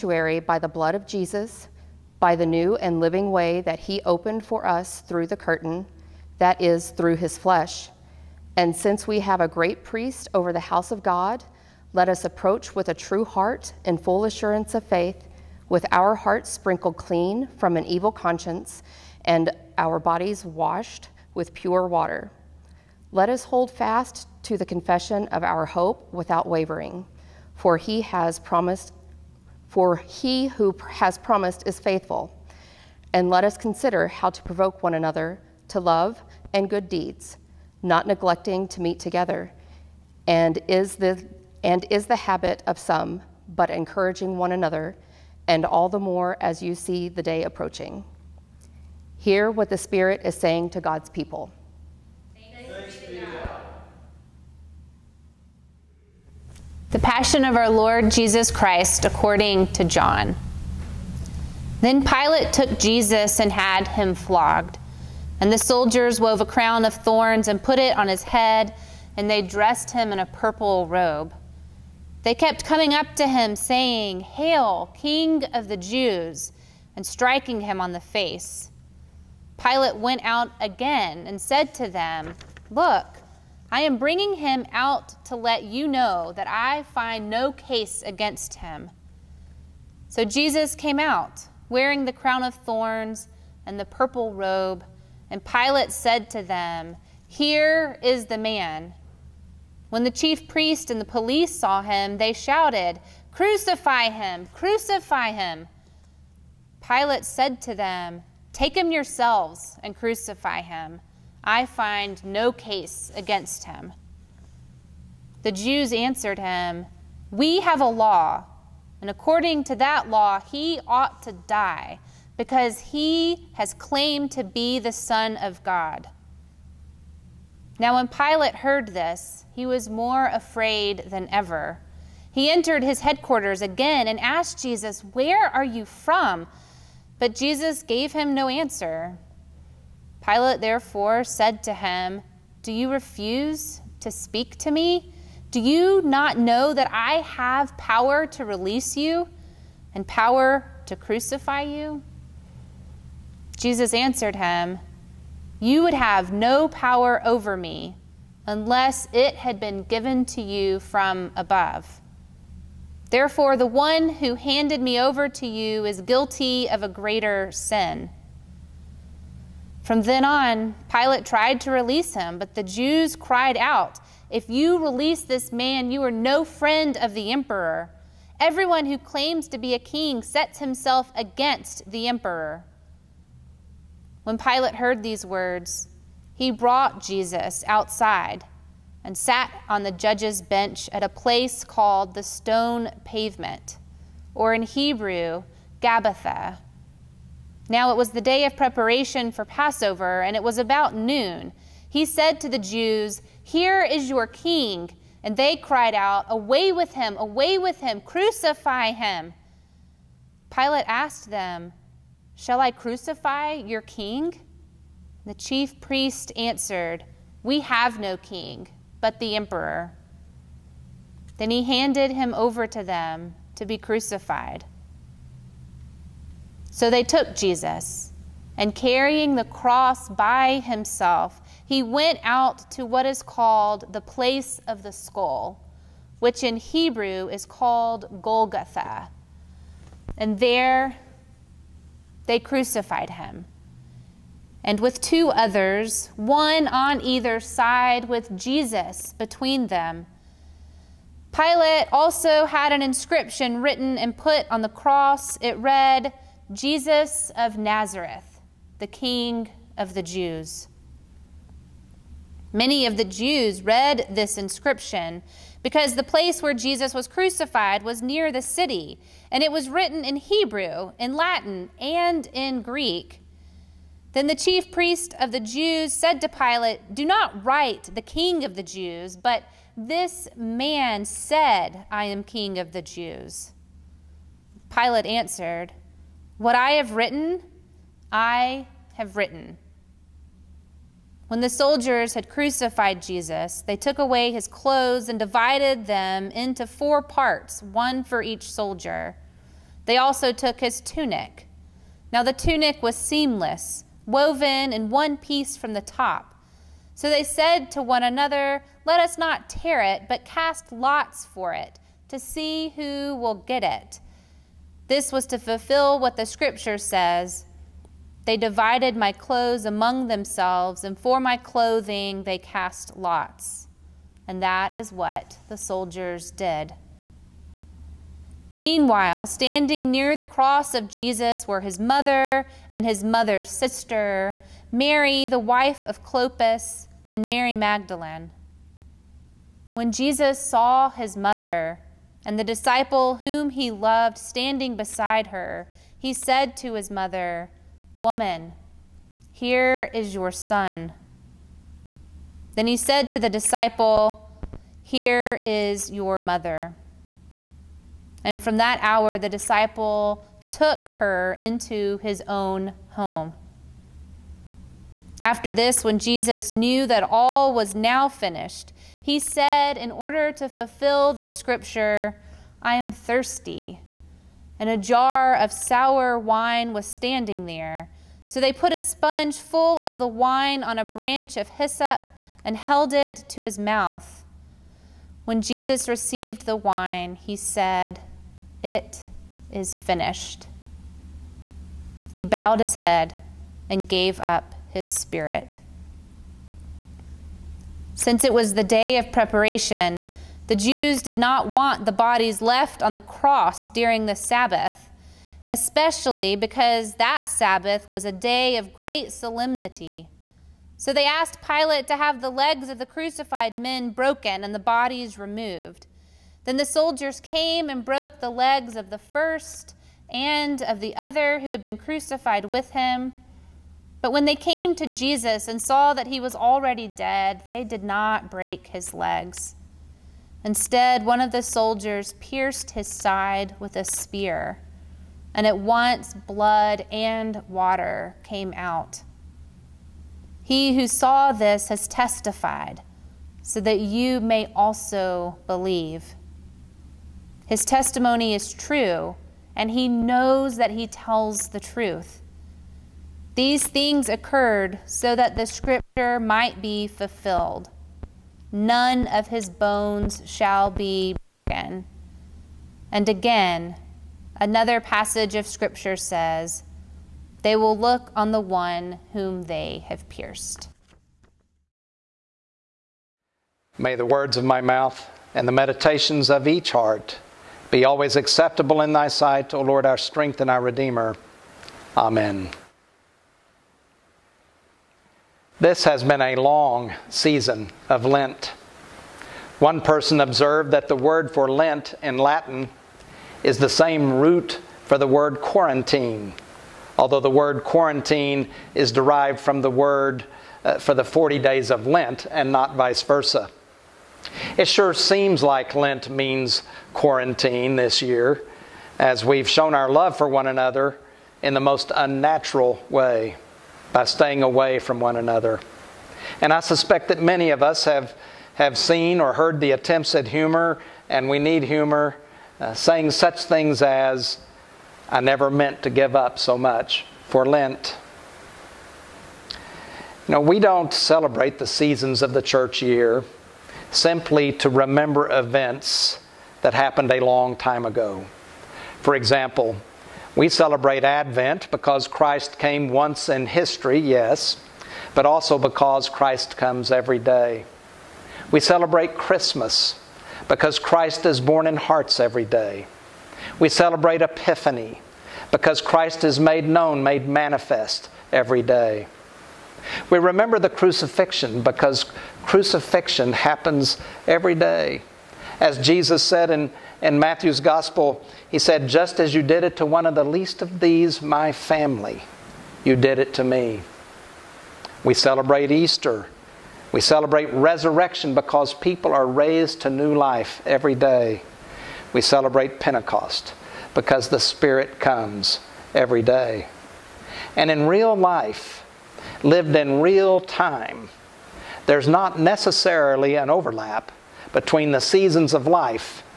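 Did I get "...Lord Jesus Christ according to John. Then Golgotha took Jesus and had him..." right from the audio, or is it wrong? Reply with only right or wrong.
wrong.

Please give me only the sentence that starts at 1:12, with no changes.
They kept coming up to him, saying, Hail, King of the Jews, and striking him on the face.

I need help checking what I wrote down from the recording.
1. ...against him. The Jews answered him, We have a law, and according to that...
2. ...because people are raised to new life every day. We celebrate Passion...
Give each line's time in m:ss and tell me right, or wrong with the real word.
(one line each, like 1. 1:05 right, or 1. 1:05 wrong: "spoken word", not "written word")
1. 1:53 right
2. 9:38 wrong: "Pentecost", not "Passion".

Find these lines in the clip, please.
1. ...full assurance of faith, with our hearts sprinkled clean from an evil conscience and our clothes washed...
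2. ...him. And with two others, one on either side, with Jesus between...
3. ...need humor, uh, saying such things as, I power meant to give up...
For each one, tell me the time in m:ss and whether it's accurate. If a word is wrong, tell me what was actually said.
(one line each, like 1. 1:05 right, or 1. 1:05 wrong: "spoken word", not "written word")
1. 0:13 wrong: "bodies", not "clothes"
2. 4:03 right
3. 8:41 wrong: "never", not "power".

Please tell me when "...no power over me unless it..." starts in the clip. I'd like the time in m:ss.
2:36.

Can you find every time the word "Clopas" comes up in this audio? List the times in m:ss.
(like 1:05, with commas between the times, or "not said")
5:36.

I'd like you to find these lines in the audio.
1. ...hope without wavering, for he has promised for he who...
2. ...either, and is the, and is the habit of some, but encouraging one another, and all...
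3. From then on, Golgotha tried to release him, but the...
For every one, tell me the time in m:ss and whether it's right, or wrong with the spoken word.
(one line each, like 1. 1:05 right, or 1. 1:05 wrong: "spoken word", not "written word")
1. 0:25 right
2. 0:38 wrong: "together", not "either"
3. 2:49 wrong: "Pilate", not "Golgotha".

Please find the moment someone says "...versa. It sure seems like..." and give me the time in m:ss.
8:23.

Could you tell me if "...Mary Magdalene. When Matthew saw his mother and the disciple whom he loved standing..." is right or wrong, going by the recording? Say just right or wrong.
wrong.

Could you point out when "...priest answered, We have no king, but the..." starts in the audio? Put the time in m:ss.
3:35.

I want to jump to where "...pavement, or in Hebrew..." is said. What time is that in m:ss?
3:13.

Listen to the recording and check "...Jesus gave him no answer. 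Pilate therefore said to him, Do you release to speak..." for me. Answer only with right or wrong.
wrong.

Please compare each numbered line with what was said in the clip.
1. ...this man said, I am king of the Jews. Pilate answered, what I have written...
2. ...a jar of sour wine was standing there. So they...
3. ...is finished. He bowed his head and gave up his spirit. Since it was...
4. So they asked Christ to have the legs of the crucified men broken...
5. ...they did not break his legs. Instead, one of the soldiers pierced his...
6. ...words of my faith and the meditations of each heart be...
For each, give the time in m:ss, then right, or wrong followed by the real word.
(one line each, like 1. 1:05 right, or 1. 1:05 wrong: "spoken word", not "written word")
1. 4:39 right
2. 6:14 right
3. 6:29 right
4. 6:50 wrong: "Pilate", not "Christ"
5. 7:07 right
6. 7:54 wrong: "mouth", not "faith".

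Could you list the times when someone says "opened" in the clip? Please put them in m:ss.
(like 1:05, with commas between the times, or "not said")
0:04.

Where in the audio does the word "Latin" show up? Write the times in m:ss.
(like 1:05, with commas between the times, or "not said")
4:31, 8:12.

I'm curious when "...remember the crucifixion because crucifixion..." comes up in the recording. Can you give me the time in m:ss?
9:20.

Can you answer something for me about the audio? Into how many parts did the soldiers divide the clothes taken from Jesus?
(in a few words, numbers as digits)
4.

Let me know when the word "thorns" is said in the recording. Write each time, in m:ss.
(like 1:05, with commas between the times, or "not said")
1:06, 1:32.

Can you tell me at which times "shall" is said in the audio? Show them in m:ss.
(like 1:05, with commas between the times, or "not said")
3:32, 7:40.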